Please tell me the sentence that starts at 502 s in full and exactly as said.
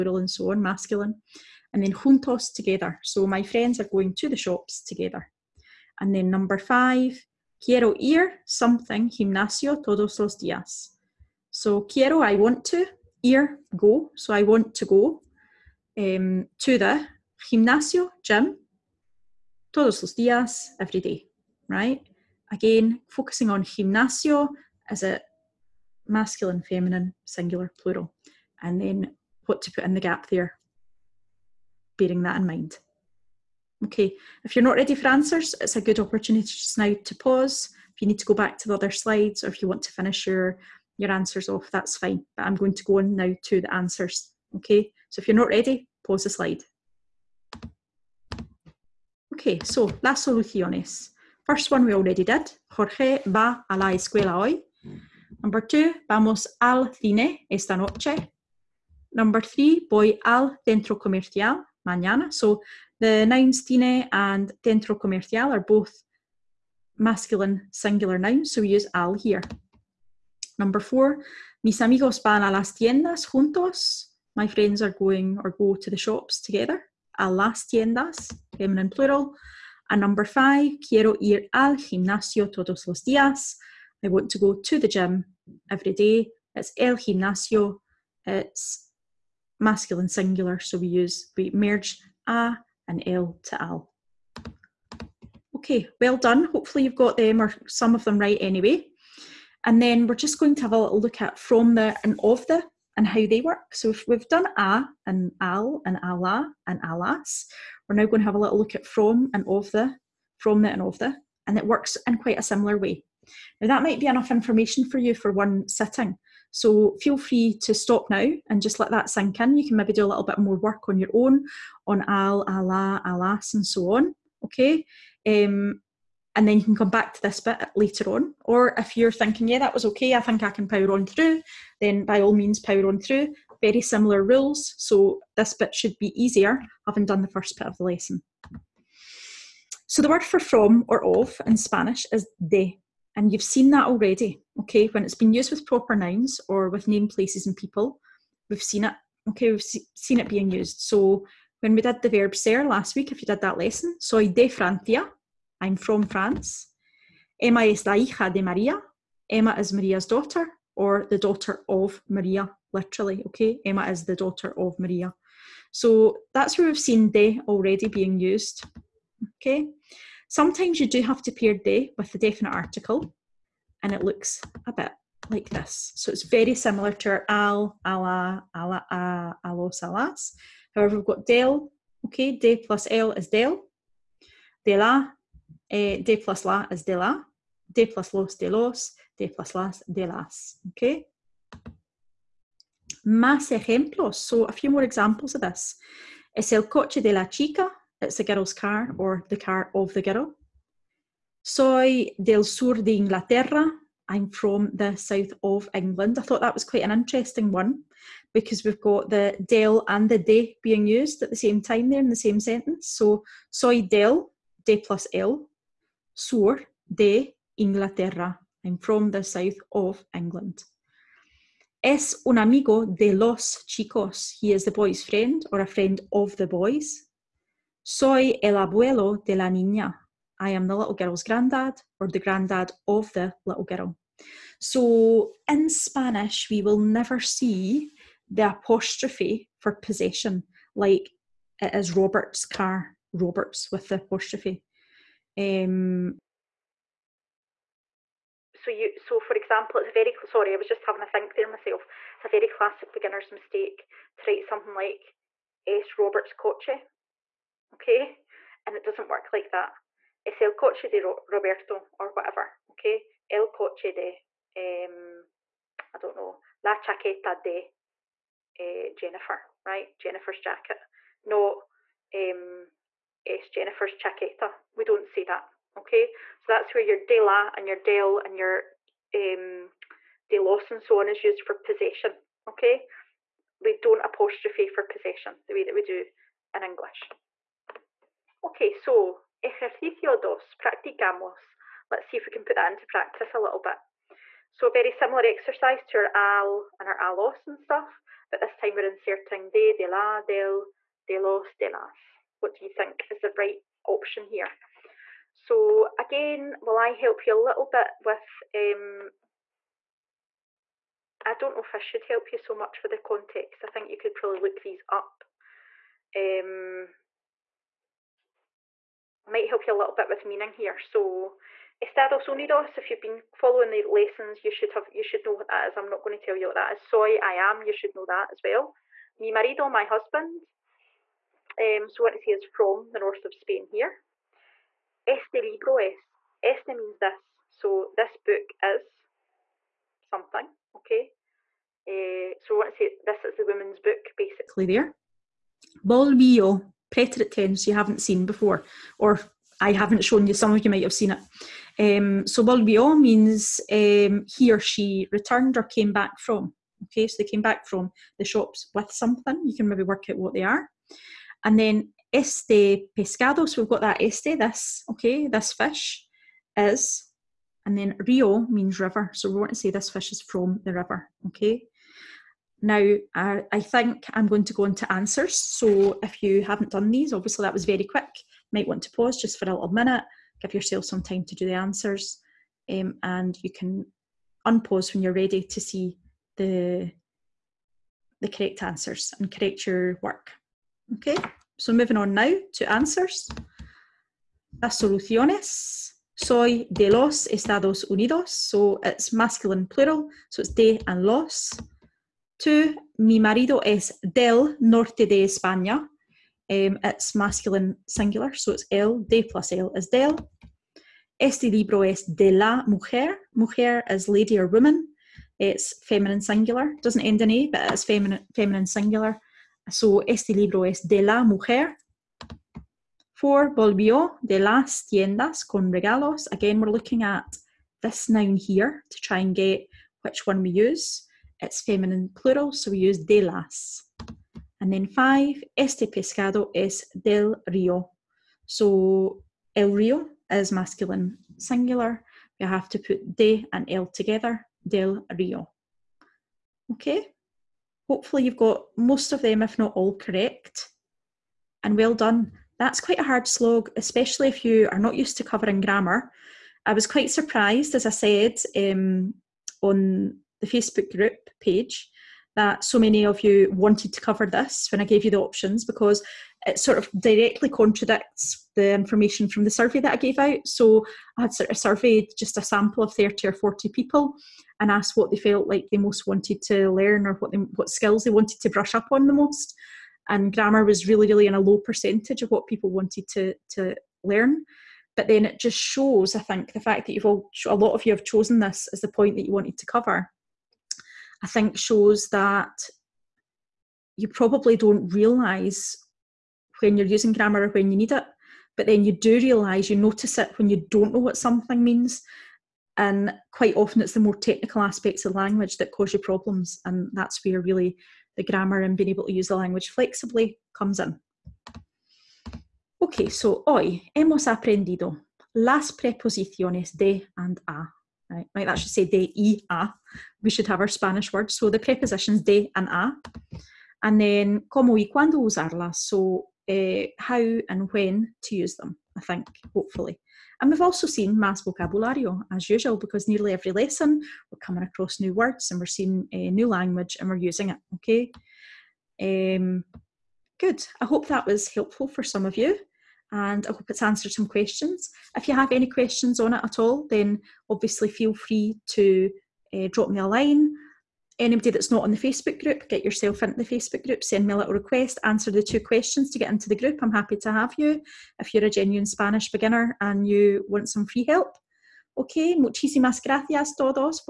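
And quite often it's the more technical aspects of language that cause you problems.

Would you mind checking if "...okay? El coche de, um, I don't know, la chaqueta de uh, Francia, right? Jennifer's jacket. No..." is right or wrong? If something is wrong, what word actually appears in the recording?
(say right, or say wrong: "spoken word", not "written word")
wrong: "Jennifer", not "Francia".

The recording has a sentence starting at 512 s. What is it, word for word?
Okay, so hoy hemos aprendido las preposiciones de and a.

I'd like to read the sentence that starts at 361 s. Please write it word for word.
And then este pescado, so we've got that este, this, okay, this fish is.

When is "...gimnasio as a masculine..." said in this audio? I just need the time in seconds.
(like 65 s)
23 s.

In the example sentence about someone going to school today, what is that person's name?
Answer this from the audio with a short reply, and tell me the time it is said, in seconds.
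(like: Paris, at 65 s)
Jorge, at 52 s.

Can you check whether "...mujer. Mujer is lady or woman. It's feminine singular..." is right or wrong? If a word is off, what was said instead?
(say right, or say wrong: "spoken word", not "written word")
right.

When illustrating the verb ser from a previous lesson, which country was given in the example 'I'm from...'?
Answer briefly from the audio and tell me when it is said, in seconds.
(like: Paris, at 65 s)
Francia, at 154 s.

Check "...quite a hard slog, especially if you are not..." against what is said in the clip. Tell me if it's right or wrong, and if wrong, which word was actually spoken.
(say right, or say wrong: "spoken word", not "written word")
right.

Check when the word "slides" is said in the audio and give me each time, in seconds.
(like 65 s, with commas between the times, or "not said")
38 s, 46 s.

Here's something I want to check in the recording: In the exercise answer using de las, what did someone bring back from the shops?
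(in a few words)
regalos.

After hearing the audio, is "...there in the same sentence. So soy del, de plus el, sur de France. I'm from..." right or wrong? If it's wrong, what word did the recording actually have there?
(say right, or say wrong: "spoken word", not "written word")
wrong: "Inglaterra", not "France".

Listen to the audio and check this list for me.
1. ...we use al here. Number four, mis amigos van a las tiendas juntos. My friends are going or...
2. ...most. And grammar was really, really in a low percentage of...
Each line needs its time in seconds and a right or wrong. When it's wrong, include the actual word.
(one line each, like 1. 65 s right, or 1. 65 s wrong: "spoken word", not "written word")
1. 68 s right
2. 479 s right.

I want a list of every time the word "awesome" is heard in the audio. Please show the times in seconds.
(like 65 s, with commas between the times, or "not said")
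not said.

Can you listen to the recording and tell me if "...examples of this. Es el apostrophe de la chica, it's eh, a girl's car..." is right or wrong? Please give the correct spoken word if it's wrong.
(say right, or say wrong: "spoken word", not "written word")
wrong: "coche", not "apostrophe".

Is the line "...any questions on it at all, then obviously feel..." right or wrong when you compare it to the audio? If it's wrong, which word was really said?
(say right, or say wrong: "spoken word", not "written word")
right.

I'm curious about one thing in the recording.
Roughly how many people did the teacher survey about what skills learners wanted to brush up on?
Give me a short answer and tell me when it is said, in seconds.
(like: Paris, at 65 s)
30 or 40, at 472 s.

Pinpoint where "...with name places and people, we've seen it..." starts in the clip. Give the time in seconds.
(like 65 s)
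146 s.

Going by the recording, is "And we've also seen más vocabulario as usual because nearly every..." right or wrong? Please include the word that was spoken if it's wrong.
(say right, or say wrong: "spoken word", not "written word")
right.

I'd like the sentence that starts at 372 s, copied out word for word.
Now, I, I think I'm going to go into answers.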